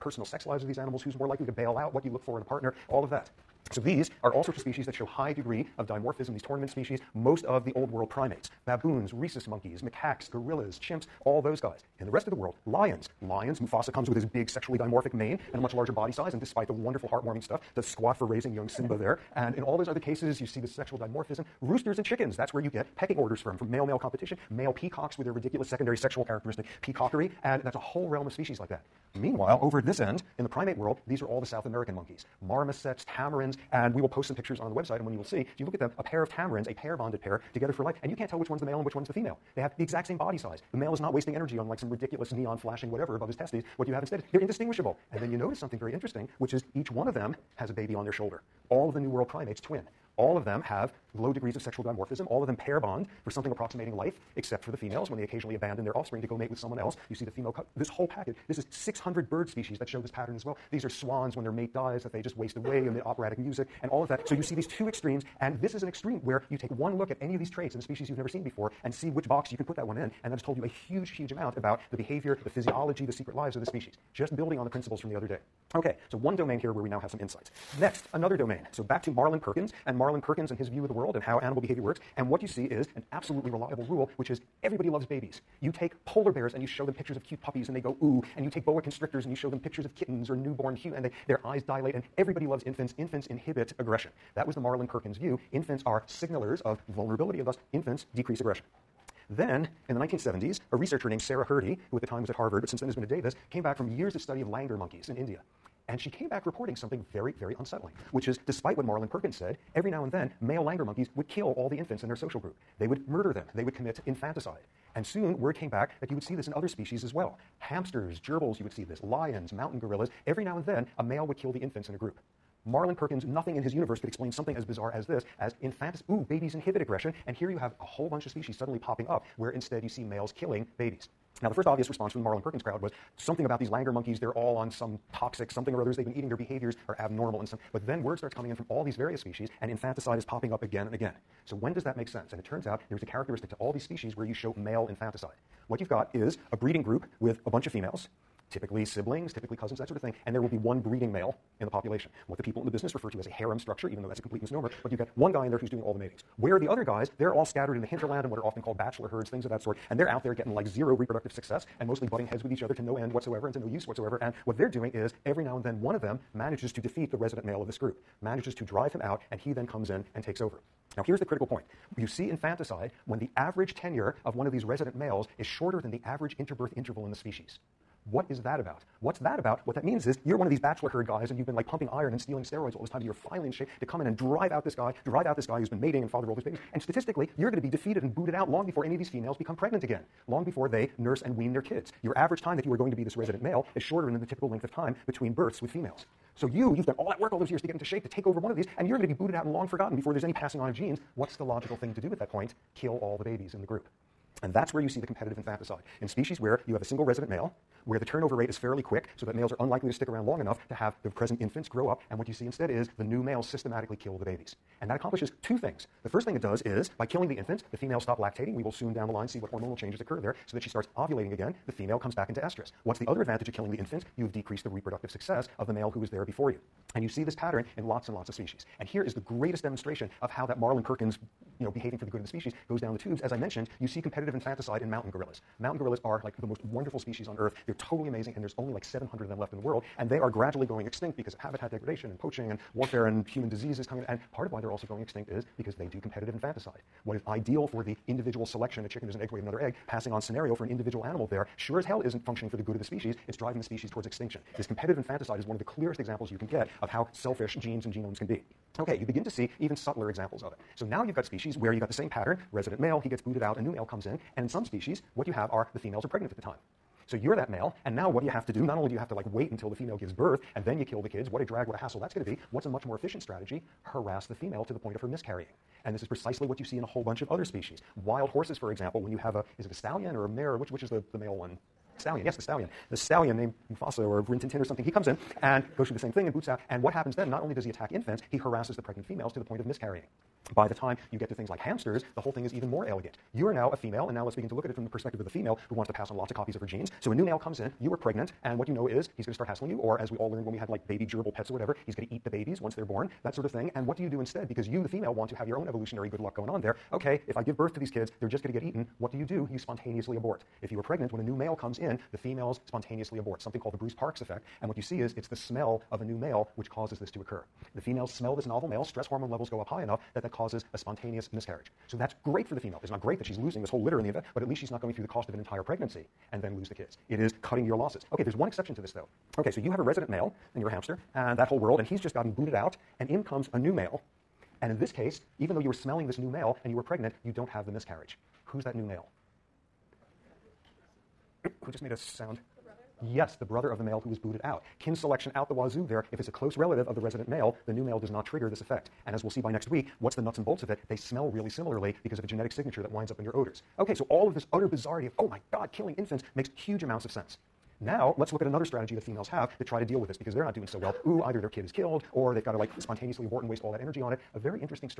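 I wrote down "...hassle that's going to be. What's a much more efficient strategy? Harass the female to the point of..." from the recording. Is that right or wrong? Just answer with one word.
right.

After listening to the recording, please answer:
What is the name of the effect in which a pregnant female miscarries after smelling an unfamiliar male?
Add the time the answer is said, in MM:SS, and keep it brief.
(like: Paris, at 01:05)
Bruce Parkes effect, at 05:13.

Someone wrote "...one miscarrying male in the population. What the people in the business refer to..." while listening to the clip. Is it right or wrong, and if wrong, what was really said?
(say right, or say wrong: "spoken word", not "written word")
wrong: "breeding", not "miscarrying".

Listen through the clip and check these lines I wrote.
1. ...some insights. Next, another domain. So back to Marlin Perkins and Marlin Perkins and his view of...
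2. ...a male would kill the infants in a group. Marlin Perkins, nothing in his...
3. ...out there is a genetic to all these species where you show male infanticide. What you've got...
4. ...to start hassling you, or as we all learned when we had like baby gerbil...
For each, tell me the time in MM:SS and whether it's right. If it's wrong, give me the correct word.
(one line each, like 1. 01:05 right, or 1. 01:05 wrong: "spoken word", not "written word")
1. 01:17 right
2. 02:00 right
3. 02:22 wrong: "characteristic", not "genetic"
4. 04:59 right.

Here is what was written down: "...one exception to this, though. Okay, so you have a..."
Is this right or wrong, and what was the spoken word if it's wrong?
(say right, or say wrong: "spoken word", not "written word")
right.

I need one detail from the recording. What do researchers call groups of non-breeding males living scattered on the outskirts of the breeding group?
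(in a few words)
bachelor herds.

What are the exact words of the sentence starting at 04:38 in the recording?
Wild horses, for example, when you have a, is it a stallion or a mare?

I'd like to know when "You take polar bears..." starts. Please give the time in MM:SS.
01:25.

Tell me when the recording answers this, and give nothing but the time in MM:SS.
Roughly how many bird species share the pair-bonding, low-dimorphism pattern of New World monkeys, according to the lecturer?
00:58.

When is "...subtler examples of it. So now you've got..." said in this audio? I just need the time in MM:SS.
04:19.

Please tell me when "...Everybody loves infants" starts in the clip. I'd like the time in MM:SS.
01:32.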